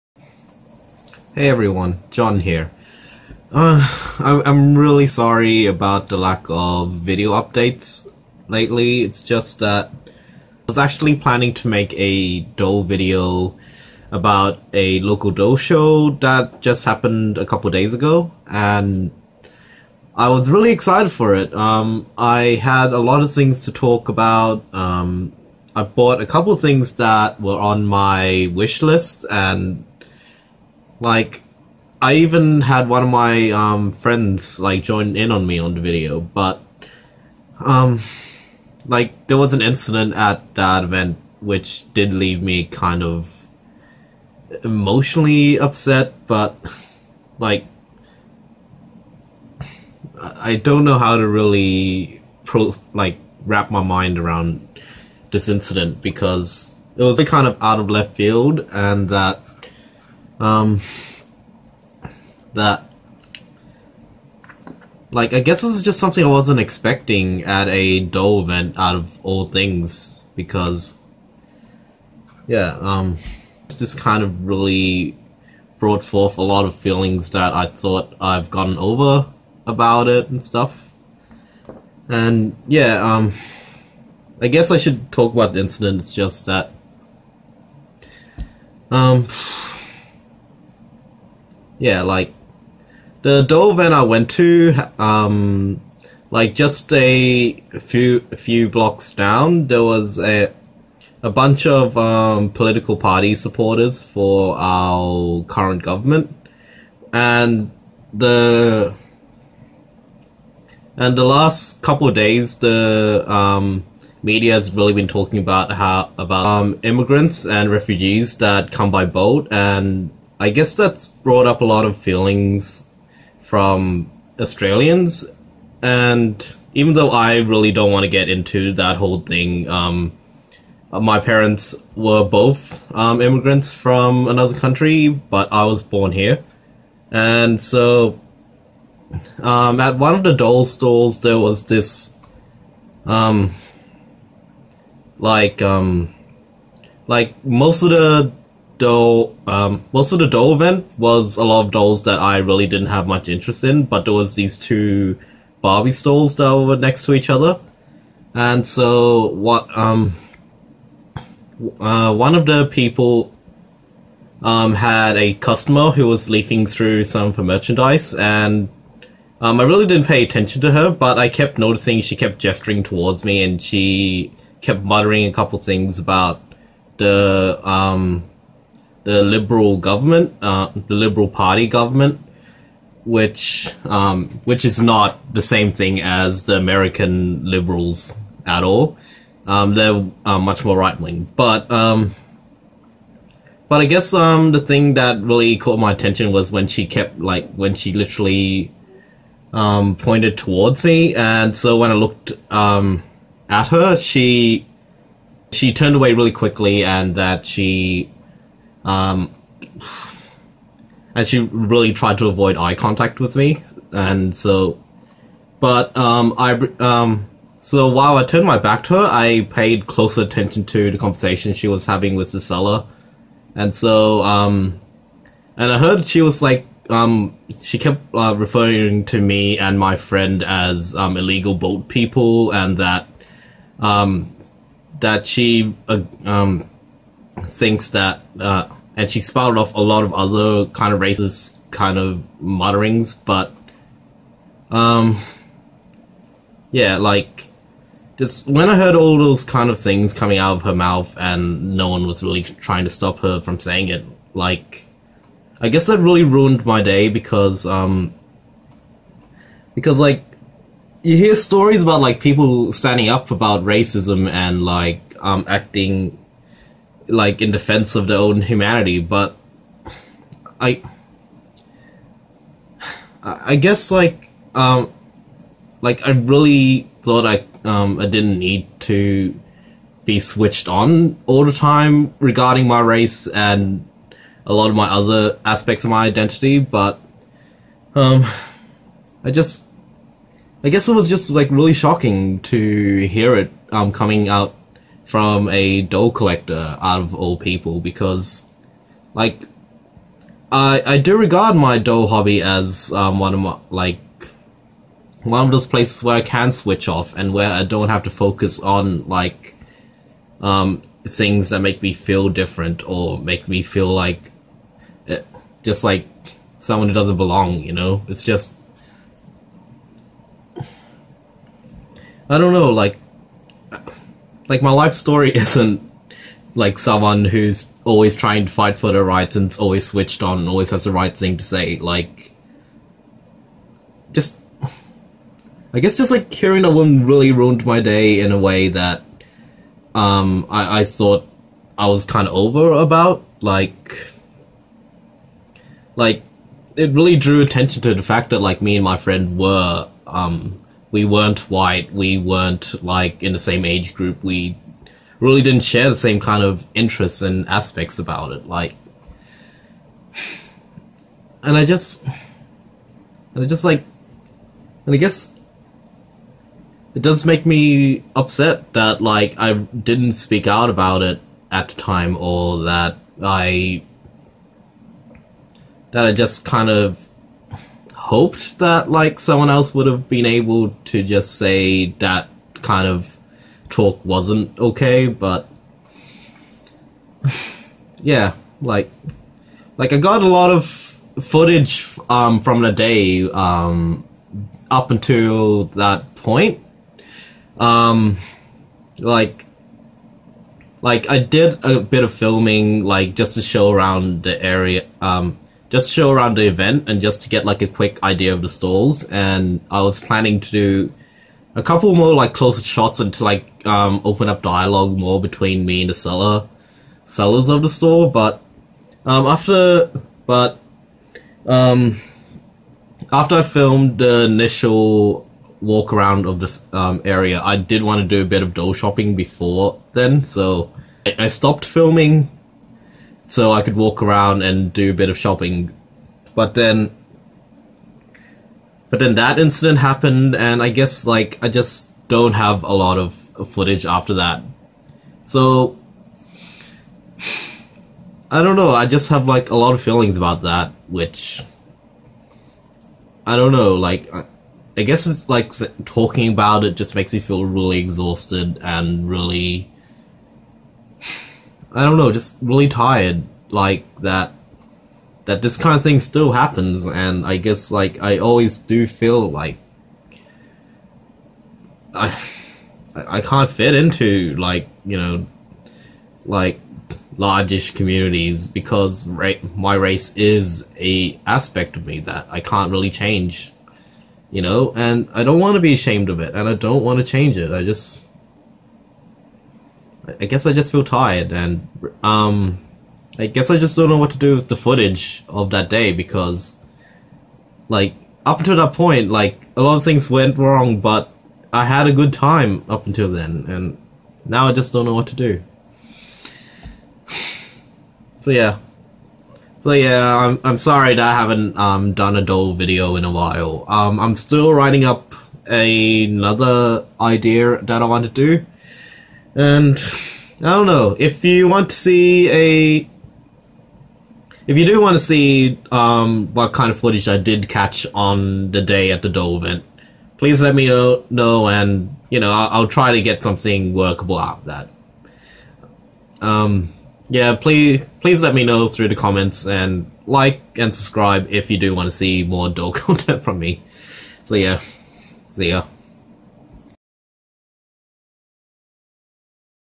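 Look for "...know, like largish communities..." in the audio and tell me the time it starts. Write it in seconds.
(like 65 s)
474 s.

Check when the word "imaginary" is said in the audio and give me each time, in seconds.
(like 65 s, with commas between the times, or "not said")
not said.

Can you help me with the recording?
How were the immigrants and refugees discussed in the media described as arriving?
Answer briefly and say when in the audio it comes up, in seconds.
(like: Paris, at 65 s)
by boat, at 118 s.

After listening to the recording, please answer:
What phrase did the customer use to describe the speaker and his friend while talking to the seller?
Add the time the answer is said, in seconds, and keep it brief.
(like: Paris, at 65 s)
illegal boat people, at 231 s.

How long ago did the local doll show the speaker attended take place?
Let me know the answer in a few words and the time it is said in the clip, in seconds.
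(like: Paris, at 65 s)
a couple days ago, at 17 s.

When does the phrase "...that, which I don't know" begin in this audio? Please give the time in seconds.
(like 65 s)
450 s.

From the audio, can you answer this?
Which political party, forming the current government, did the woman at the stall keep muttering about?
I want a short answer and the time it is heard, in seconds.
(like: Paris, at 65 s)
Liberal Party, at 180 s.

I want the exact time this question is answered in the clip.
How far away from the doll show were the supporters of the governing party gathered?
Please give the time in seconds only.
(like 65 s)
98 s.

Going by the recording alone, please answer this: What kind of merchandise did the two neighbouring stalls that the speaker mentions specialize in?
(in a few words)
Barbie.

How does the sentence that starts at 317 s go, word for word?
You know, it's just I don't know.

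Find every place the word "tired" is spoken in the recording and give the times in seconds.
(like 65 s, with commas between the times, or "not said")
462 s, 490 s.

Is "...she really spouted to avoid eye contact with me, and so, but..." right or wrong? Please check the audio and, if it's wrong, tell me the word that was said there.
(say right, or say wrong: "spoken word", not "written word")
wrong: "tried", not "spouted".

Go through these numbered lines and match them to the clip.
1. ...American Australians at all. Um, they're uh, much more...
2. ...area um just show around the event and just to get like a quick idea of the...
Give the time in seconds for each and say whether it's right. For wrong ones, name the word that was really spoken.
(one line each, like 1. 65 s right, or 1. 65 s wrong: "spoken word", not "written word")
1. 186 s wrong: "Liberals", not "Australians"
2. 404 s right.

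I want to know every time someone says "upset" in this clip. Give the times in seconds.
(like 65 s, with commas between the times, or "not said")
45 s, 368 s.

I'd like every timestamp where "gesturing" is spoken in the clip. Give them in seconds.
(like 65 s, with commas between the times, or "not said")
172 s.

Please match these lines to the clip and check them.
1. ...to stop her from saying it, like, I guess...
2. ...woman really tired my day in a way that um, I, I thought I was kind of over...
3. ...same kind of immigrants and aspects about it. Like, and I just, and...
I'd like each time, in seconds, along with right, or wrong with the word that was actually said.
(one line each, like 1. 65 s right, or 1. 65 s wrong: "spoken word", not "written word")
1. 252 s right
2. 336 s wrong: "ruined", not "tired"
3. 355 s wrong: "interests", not "immigrants".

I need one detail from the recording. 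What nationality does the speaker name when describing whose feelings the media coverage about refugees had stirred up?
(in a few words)
Australians.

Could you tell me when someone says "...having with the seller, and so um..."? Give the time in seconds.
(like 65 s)
221 s.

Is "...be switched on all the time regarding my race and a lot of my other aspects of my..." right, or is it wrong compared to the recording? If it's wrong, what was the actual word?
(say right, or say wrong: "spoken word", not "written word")
right.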